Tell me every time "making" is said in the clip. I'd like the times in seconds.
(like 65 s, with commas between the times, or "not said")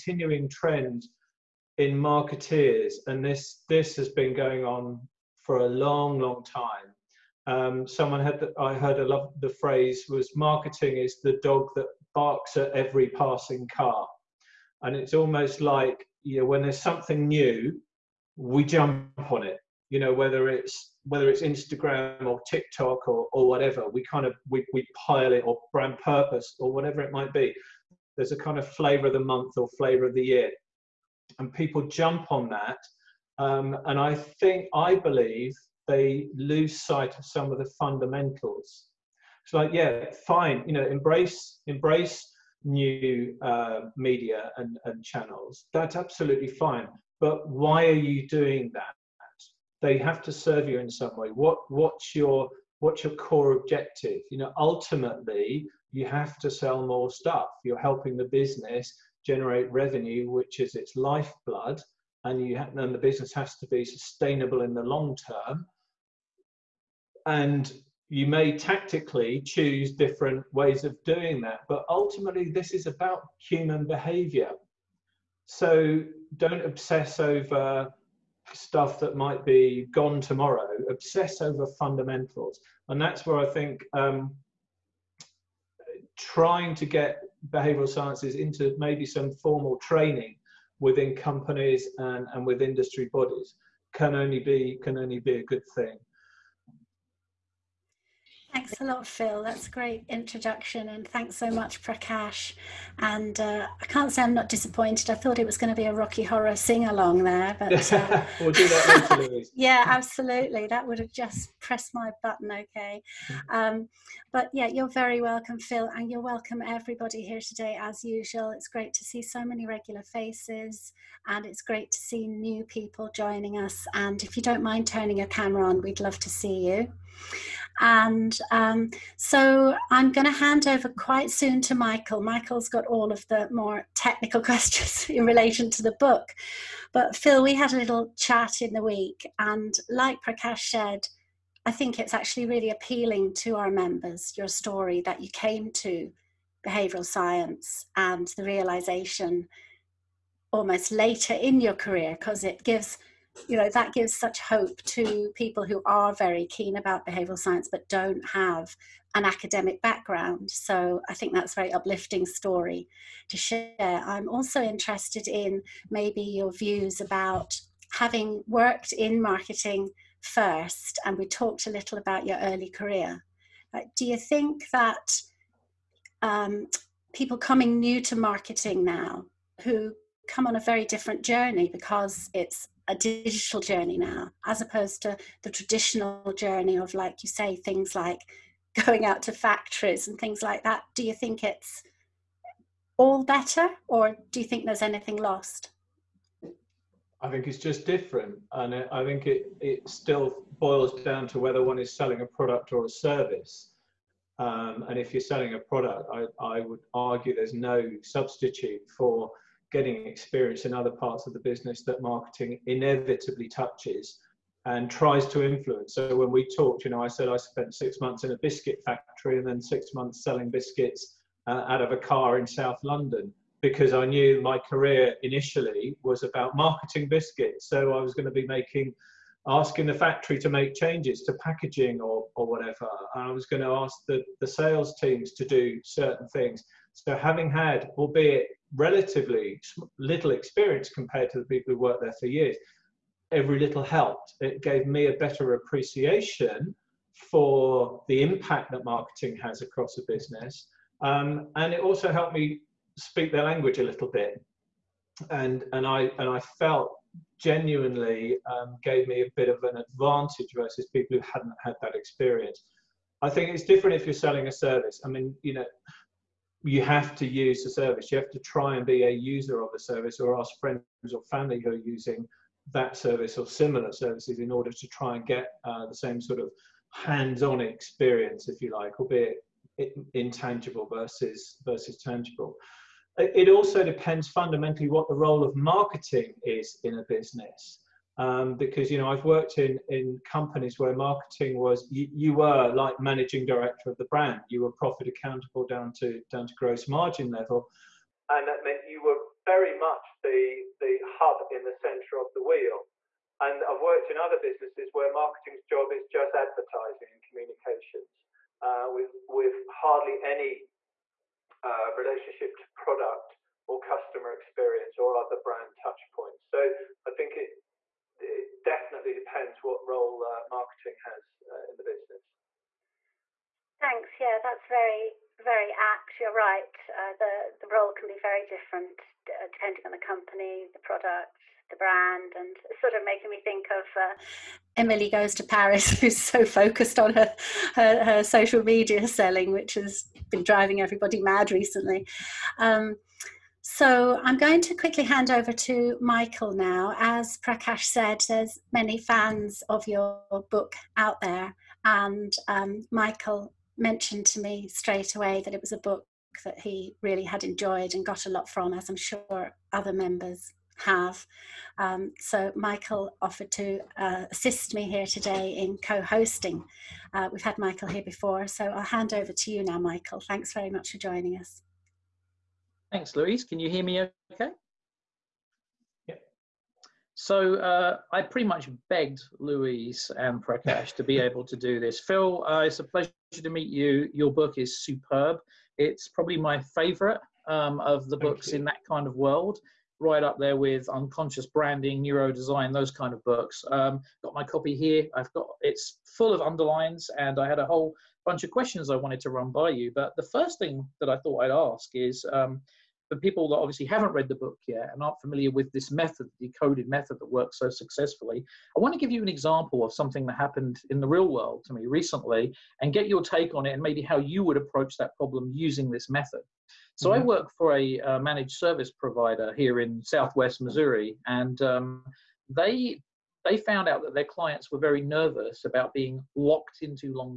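228 s, 333 s.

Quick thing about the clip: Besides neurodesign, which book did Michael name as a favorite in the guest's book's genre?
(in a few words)
Unconscious Branding.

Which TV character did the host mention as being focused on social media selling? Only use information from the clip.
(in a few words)
Emily.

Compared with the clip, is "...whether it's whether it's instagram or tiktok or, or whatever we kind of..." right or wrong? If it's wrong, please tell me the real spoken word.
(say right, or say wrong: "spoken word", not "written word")
right.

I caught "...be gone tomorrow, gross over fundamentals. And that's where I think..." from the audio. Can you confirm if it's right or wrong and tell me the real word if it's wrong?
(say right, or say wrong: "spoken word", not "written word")
wrong: "obsess", not "gross".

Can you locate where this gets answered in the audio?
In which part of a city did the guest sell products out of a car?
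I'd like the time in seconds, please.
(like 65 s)
222 s.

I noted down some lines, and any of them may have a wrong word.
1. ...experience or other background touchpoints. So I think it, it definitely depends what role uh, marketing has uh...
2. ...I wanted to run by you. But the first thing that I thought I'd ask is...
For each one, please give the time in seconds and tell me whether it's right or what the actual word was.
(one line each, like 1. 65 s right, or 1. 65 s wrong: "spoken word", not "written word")
1. 314 s wrong: "brand", not "background"
2. 398 s right.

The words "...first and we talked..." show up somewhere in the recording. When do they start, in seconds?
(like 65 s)
170 s.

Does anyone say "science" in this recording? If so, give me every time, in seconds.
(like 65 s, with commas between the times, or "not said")
87 s, 147 s, 157 s.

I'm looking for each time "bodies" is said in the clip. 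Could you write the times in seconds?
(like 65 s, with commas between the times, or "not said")
93 s.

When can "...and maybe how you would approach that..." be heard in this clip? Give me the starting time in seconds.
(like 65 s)
413 s.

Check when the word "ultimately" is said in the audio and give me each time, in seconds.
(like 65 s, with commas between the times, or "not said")
54 s, 71 s.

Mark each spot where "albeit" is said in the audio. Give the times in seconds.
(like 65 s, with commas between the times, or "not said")
237 s, 278 s.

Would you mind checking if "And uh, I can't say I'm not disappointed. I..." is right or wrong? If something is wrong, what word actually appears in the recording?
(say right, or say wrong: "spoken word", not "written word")
right.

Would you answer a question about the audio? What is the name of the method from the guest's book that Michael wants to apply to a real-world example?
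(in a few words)
decoded method.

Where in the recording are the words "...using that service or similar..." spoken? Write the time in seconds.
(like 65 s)
271 s.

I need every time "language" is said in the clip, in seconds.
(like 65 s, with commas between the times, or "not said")
253 s.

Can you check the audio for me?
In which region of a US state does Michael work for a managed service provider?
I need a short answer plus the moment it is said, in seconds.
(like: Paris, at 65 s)
Southwest Missouri, at 420 s.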